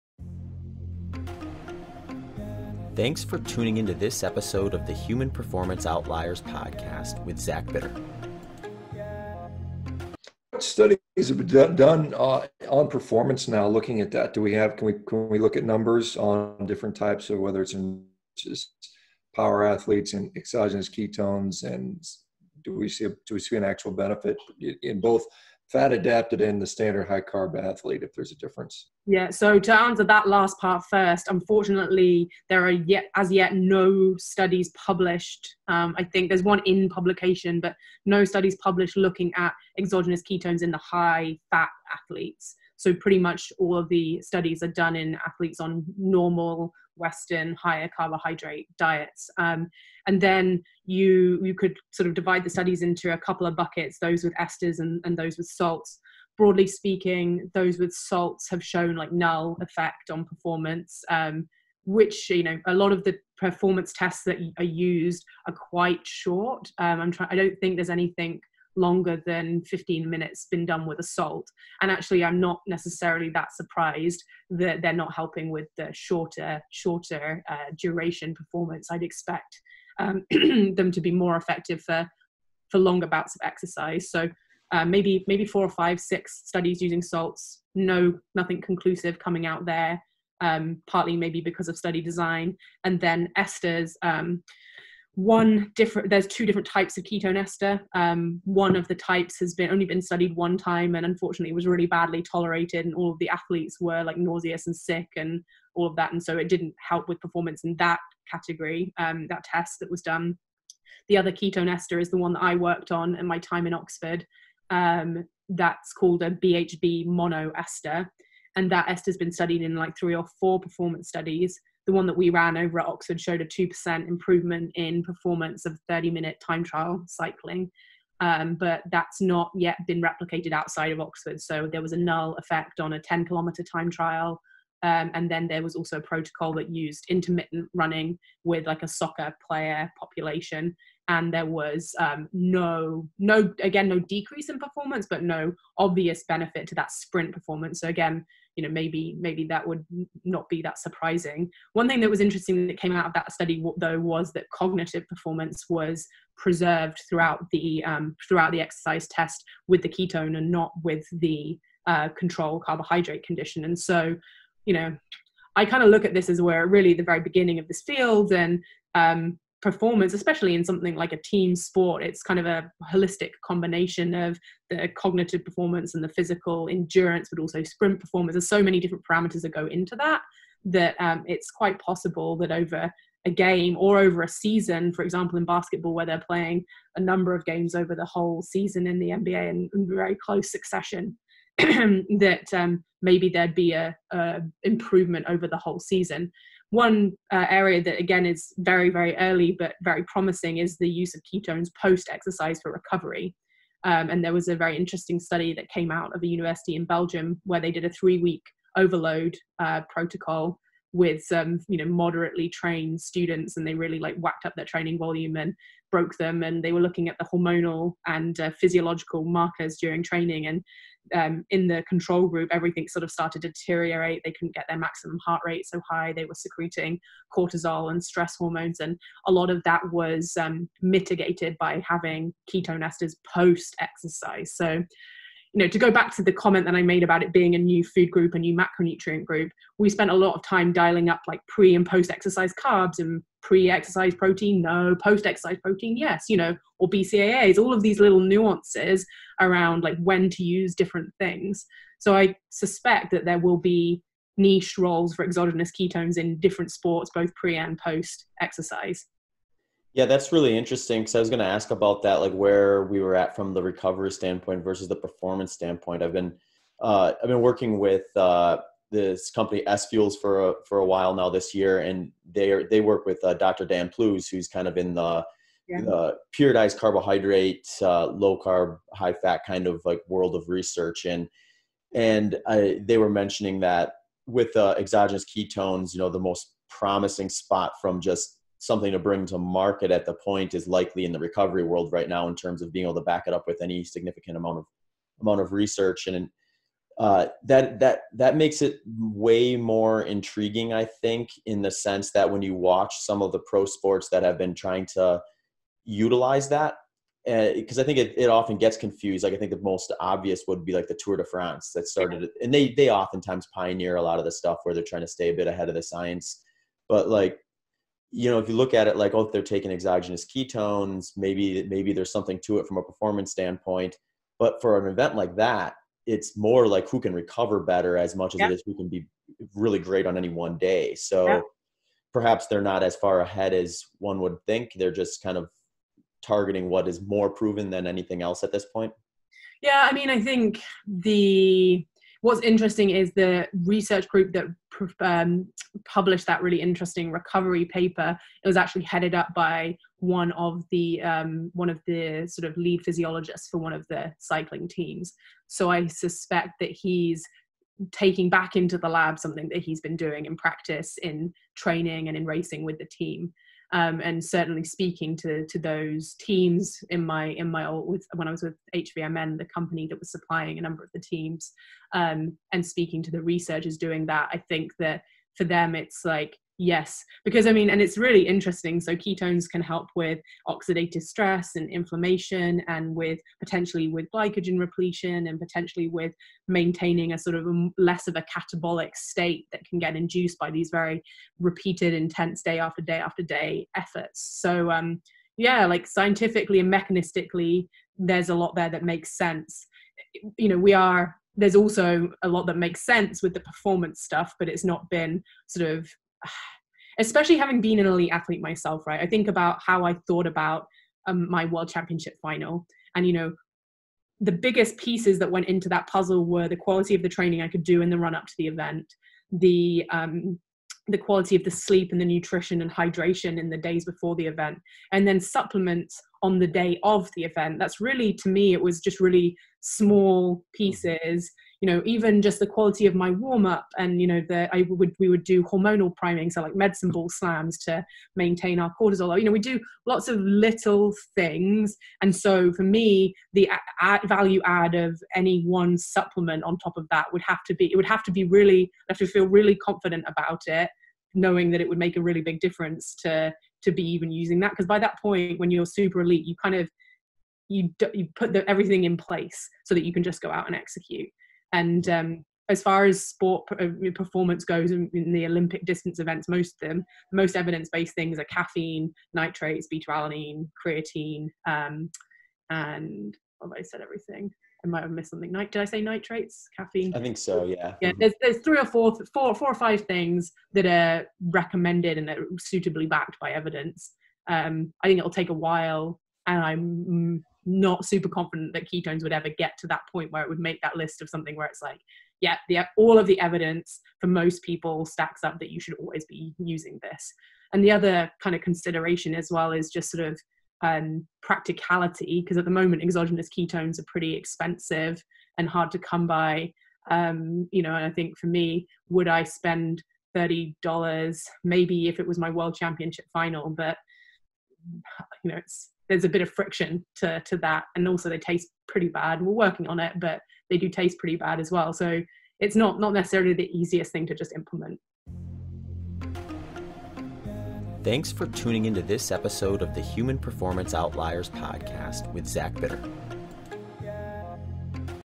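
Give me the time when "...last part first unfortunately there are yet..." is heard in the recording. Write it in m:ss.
0:30.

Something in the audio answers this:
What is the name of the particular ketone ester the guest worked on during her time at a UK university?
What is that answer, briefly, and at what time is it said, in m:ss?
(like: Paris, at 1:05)
BHB monoester, at 1:56.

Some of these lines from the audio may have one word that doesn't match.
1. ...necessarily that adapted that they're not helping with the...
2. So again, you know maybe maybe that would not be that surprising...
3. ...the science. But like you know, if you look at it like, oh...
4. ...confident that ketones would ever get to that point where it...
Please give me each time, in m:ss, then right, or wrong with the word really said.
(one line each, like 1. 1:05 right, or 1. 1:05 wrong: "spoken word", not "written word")
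1. 1:12 wrong: "surprised", not "adapted"
2. 2:27 right
3. 5:15 right
4. 8:08 right.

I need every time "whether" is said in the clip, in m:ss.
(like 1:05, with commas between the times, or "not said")
0:17.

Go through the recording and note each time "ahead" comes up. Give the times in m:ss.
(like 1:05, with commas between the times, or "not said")
5:15, 5:33.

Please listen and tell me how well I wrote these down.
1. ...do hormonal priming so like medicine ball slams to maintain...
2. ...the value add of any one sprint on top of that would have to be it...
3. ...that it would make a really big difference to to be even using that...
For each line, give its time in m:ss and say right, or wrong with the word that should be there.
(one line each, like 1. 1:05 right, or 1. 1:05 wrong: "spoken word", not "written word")
1. 7:15 right
2. 7:23 wrong: "supplement", not "sprint"
3. 7:31 right.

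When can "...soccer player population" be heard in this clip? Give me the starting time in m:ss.
2:18.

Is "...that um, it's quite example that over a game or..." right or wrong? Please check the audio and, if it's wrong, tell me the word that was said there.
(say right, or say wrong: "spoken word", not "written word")
wrong: "possible", not "example".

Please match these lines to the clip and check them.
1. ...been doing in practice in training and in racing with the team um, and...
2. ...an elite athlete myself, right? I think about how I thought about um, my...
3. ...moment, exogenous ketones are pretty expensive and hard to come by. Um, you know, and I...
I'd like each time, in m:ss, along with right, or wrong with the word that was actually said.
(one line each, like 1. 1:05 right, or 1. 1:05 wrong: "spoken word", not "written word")
1. 5:59 right
2. 6:47 right
3. 8:22 right.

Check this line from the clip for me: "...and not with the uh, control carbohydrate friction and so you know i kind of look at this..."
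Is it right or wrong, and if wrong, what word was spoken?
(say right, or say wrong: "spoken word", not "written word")
wrong: "condition", not "friction".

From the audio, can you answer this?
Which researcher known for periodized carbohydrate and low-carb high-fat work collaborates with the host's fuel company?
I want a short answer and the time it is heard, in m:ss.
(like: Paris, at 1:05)
Dan Plews, at 4:33.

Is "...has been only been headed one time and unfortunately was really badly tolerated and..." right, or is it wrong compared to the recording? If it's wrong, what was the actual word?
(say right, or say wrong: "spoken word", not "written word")
wrong: "studied", not "headed".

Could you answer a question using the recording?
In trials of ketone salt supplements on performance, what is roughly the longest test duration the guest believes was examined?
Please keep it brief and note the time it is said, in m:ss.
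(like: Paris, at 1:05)
15 minutes, at 1:09.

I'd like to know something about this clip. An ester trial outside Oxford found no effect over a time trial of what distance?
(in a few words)
10 kilometers.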